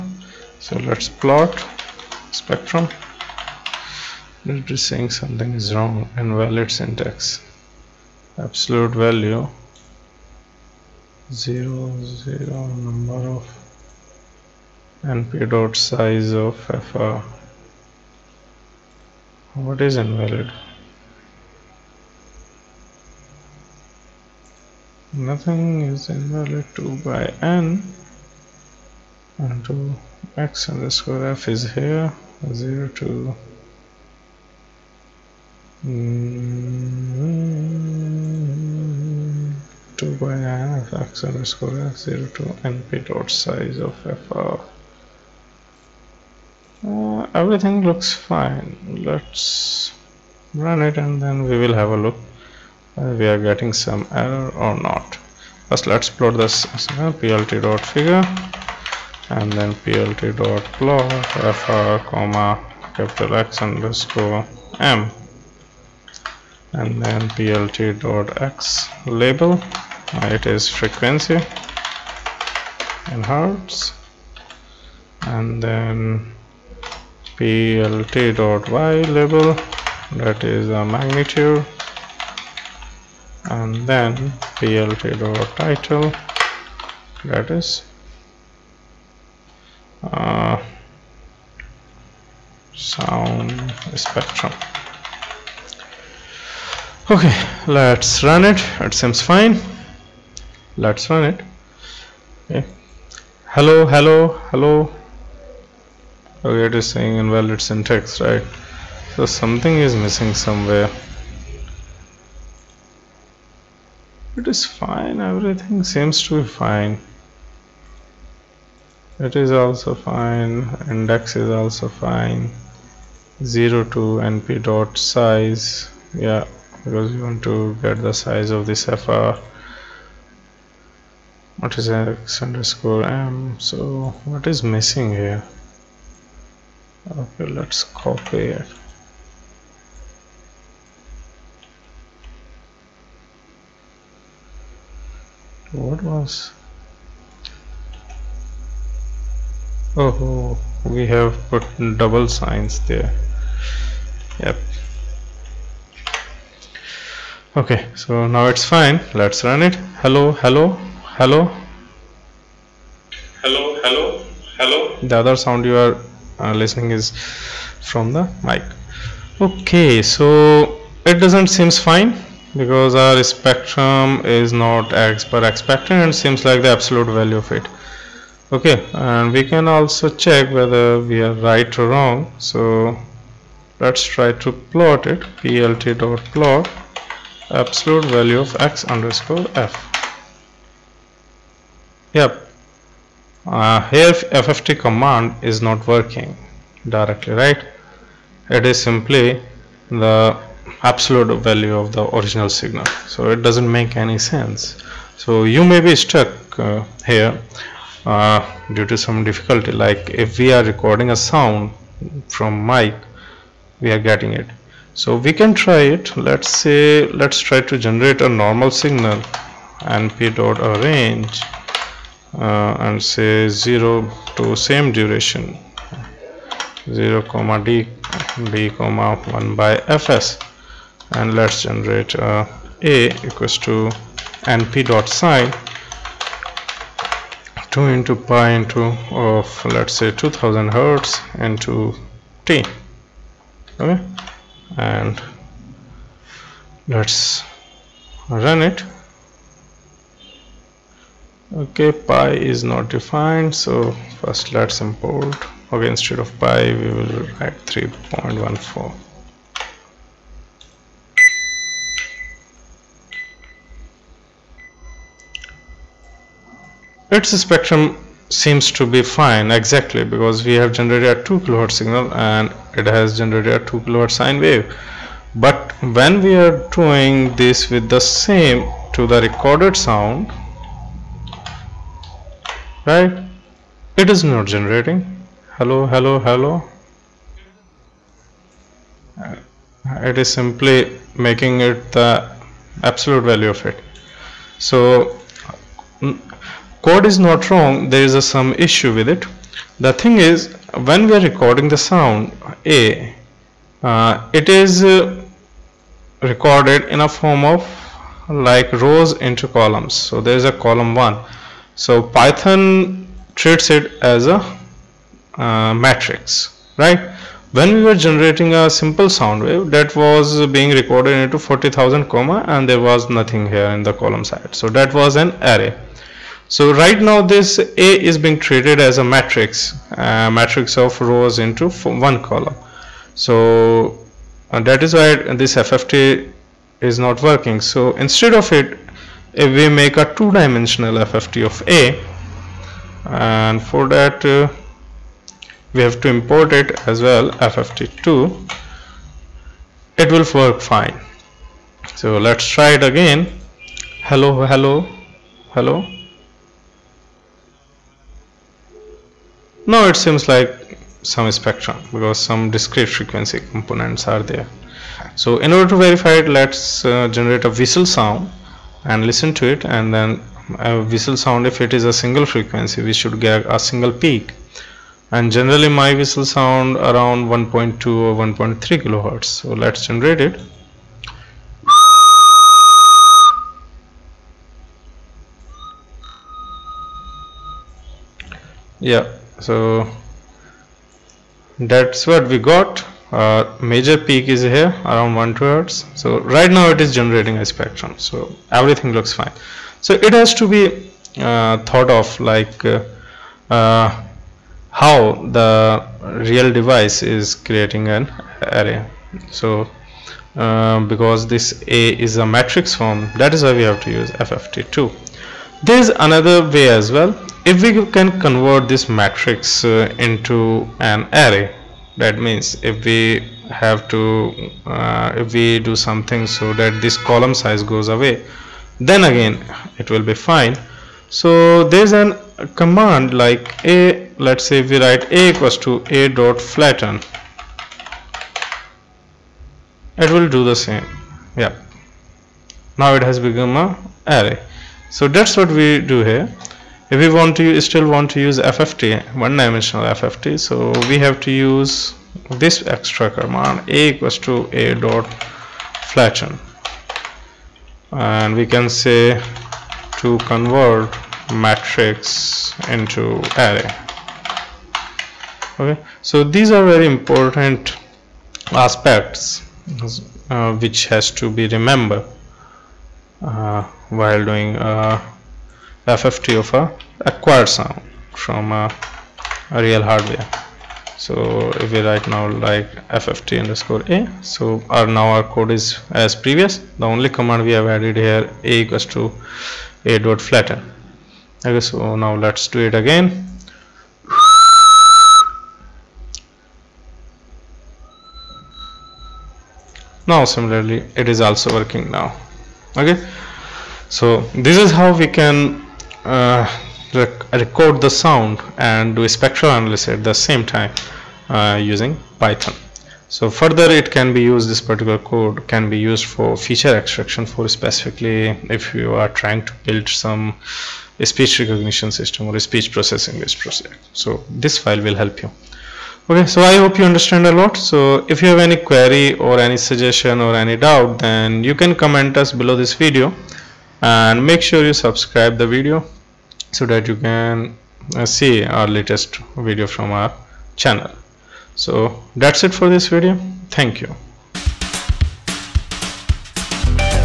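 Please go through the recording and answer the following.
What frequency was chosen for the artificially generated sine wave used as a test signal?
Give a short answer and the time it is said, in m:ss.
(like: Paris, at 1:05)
2000 hertz, at 4:00.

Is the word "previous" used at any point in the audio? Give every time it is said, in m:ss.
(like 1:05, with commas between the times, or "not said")
8:06.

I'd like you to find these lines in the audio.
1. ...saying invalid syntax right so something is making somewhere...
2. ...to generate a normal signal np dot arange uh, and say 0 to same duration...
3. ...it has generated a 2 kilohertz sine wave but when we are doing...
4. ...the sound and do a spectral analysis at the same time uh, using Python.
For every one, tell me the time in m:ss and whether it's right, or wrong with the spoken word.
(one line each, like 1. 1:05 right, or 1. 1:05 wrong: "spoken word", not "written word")
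1. 1:46 wrong: "missing", not "making"
2. 3:37 right
3. 4:32 right
4. 8:27 right.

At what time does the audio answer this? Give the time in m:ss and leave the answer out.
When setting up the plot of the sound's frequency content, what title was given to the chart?
1:32.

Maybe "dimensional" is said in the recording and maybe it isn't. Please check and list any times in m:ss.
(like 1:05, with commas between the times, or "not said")
5:40, 7:29.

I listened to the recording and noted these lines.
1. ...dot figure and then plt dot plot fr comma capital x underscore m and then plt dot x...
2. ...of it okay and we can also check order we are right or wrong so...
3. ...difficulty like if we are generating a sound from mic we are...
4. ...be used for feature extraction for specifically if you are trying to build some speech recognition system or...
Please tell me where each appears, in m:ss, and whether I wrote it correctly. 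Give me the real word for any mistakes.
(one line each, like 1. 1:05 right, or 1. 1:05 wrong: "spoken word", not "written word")
1. 0:57 right
2. 2:57 wrong: "whether", not "order"
3. 3:29 wrong: "recording", not "generating"
4. 8:35 right.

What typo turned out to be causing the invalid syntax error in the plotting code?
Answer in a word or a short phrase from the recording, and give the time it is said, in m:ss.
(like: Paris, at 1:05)
double signs, at 2:31.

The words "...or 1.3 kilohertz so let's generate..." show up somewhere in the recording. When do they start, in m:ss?
6:17.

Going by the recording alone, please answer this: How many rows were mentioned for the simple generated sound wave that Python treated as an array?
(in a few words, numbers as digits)
40,000.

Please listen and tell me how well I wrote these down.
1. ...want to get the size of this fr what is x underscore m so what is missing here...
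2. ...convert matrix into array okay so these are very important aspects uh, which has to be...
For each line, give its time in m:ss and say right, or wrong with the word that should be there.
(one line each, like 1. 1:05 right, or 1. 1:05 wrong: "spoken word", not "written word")
1. 2:07 right
2. 7:40 right.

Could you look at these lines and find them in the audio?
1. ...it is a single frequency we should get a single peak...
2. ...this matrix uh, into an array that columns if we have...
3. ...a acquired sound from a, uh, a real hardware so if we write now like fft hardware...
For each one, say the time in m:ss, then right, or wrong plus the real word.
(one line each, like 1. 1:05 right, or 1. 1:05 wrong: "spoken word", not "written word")
1. 6:11 right
2. 6:58 wrong: "means", not "columns"
3. 7:56 wrong: "underscore", not "hardware".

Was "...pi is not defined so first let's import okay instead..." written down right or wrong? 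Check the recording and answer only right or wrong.
right.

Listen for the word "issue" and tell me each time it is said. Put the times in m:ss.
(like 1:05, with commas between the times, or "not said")
4:58.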